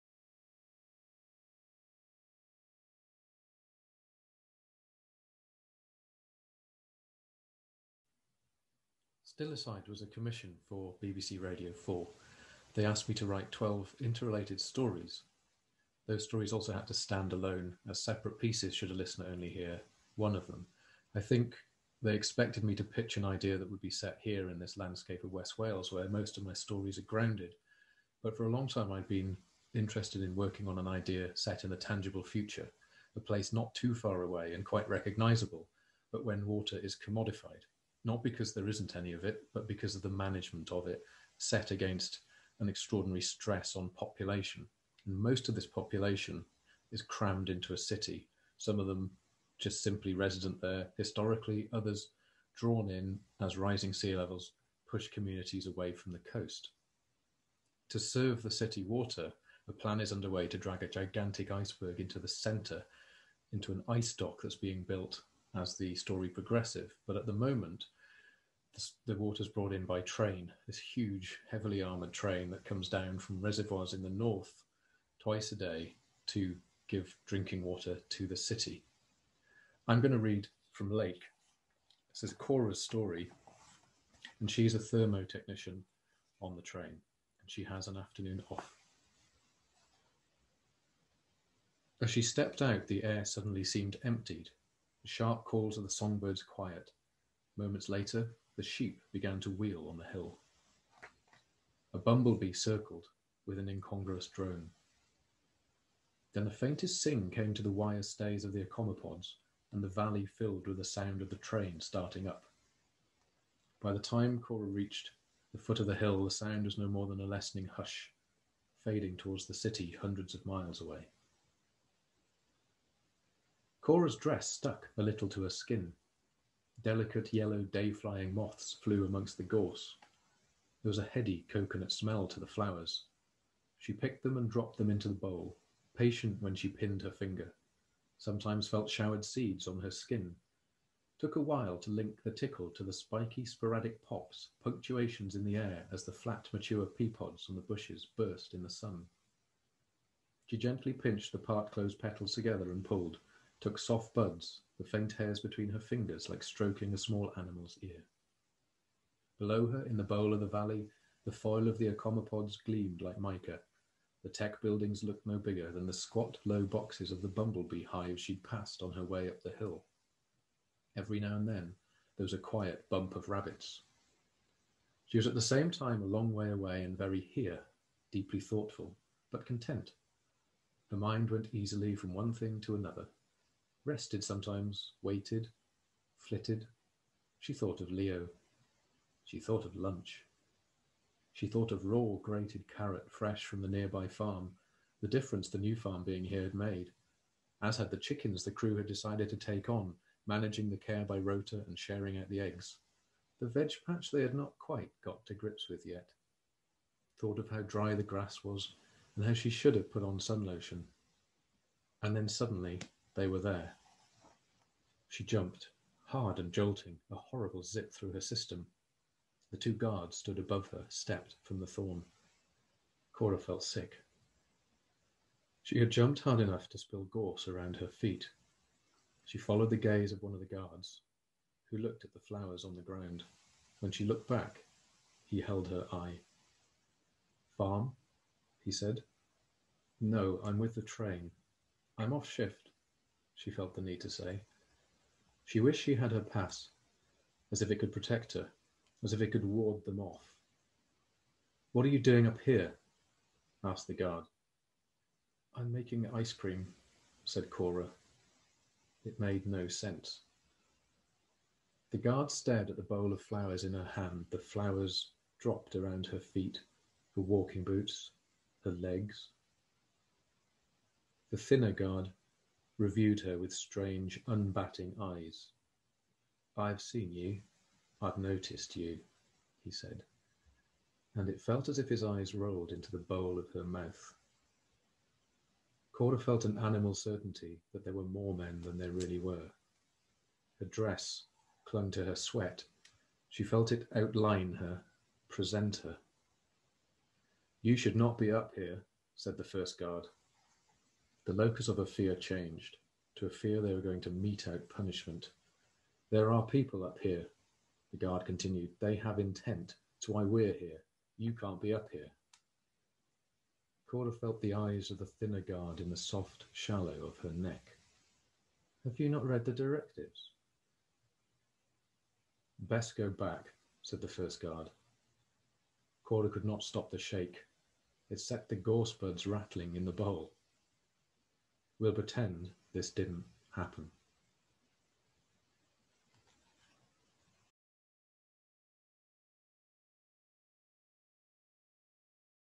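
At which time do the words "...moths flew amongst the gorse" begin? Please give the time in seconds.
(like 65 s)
128 s.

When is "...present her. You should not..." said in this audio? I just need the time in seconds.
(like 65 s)
295 s.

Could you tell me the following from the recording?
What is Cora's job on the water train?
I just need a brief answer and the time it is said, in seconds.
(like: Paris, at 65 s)
Thermo technician, at 84 s.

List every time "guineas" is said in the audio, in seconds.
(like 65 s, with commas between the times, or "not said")
not said.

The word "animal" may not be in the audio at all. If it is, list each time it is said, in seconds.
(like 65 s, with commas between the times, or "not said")
157 s, 286 s.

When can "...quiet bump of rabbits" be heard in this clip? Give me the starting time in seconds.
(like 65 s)
172 s.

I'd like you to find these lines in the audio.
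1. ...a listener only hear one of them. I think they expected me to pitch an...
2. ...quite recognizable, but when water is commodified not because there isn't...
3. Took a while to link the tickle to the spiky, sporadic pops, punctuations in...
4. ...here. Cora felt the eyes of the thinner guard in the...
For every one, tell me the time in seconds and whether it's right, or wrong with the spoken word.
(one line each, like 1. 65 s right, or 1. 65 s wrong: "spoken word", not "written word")
1. 18 s right
2. 34 s right
3. 141 s right
4. 311 s right.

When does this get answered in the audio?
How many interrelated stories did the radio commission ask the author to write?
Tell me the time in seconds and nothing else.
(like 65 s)
13 s.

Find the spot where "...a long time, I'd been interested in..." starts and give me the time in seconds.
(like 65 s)
28 s.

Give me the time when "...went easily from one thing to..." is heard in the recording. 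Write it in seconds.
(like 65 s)
181 s.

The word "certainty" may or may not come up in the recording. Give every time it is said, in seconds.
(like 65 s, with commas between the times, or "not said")
286 s.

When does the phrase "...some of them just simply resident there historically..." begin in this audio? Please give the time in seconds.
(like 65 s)
48 s.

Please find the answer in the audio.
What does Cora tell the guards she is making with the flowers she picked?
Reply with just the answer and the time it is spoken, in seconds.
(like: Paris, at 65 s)
Ice cream, at 256 s.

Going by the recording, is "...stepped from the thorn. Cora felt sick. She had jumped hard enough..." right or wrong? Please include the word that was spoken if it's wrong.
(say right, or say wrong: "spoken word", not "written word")
right.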